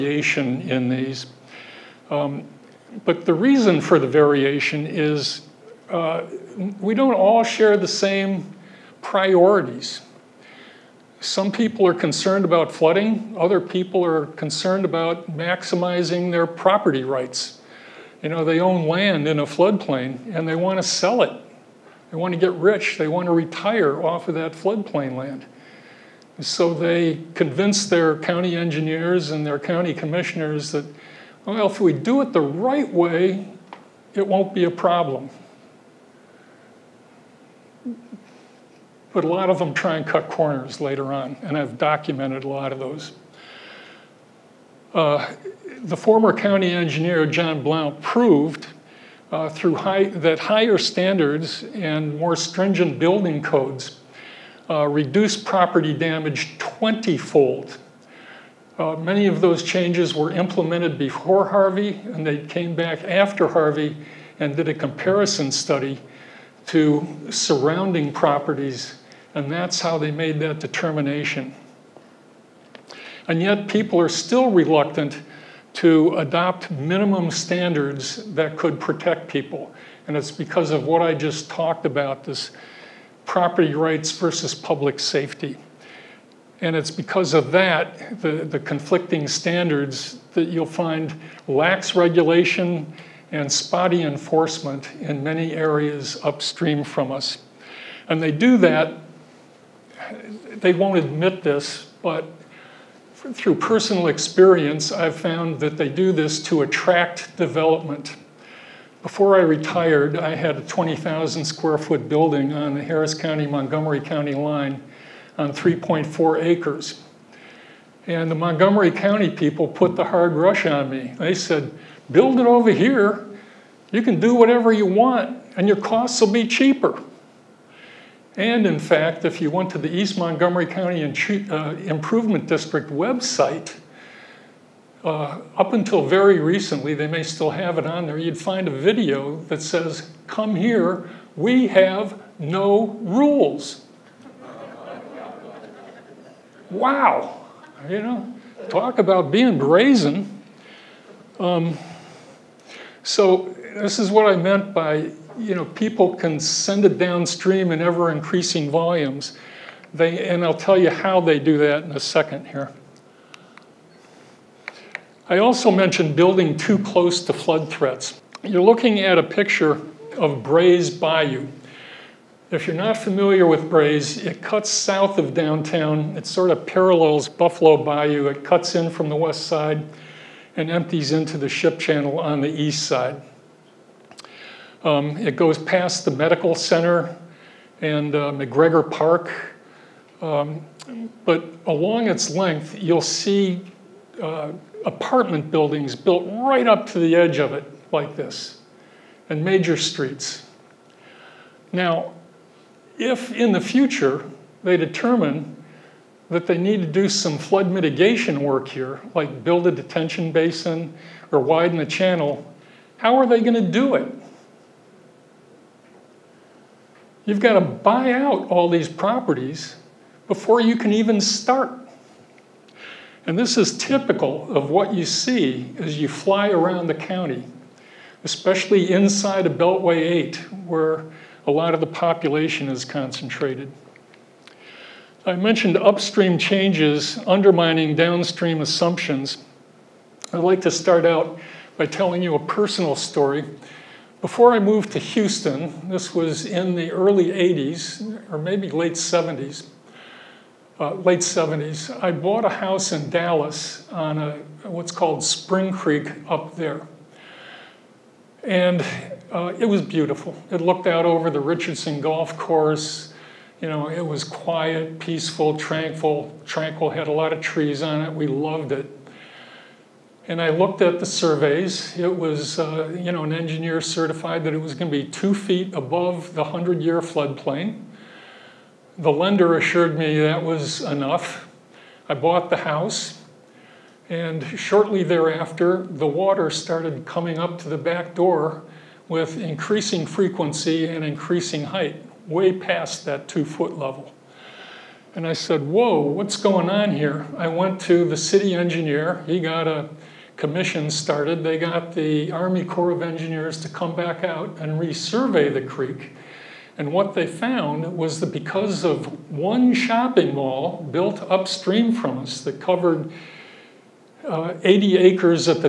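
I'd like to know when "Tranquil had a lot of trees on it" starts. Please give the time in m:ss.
4:26.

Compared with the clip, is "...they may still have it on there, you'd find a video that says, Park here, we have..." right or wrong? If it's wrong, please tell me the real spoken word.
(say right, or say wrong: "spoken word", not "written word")
wrong: "Come", not "Park".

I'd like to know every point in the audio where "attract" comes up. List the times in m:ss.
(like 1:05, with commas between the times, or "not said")
1:46.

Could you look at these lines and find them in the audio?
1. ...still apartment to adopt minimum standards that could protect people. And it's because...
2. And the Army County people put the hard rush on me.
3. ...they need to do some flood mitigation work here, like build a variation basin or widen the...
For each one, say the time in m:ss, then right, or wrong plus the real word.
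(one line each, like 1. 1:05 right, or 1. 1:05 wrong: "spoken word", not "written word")
1. 1:14 wrong: "reluctant", not "apartment"
2. 1:58 wrong: "Montgomery", not "Army"
3. 3:26 wrong: "detention", not "variation".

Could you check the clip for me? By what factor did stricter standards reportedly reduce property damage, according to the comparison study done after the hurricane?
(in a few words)
20-fold.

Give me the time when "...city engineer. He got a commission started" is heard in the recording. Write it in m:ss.
4:58.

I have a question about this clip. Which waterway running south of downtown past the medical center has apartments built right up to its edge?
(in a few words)
Bray's Bayou.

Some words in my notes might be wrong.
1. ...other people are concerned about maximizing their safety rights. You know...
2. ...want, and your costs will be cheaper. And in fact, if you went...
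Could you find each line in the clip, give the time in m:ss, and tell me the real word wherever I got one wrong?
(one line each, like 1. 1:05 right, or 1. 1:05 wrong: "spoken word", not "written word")
1. 0:13 wrong: "property", not "safety"
2. 2:04 right.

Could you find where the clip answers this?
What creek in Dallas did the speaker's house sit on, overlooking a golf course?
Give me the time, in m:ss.
4:15.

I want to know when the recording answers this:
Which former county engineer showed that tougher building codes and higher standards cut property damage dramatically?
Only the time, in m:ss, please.
0:47.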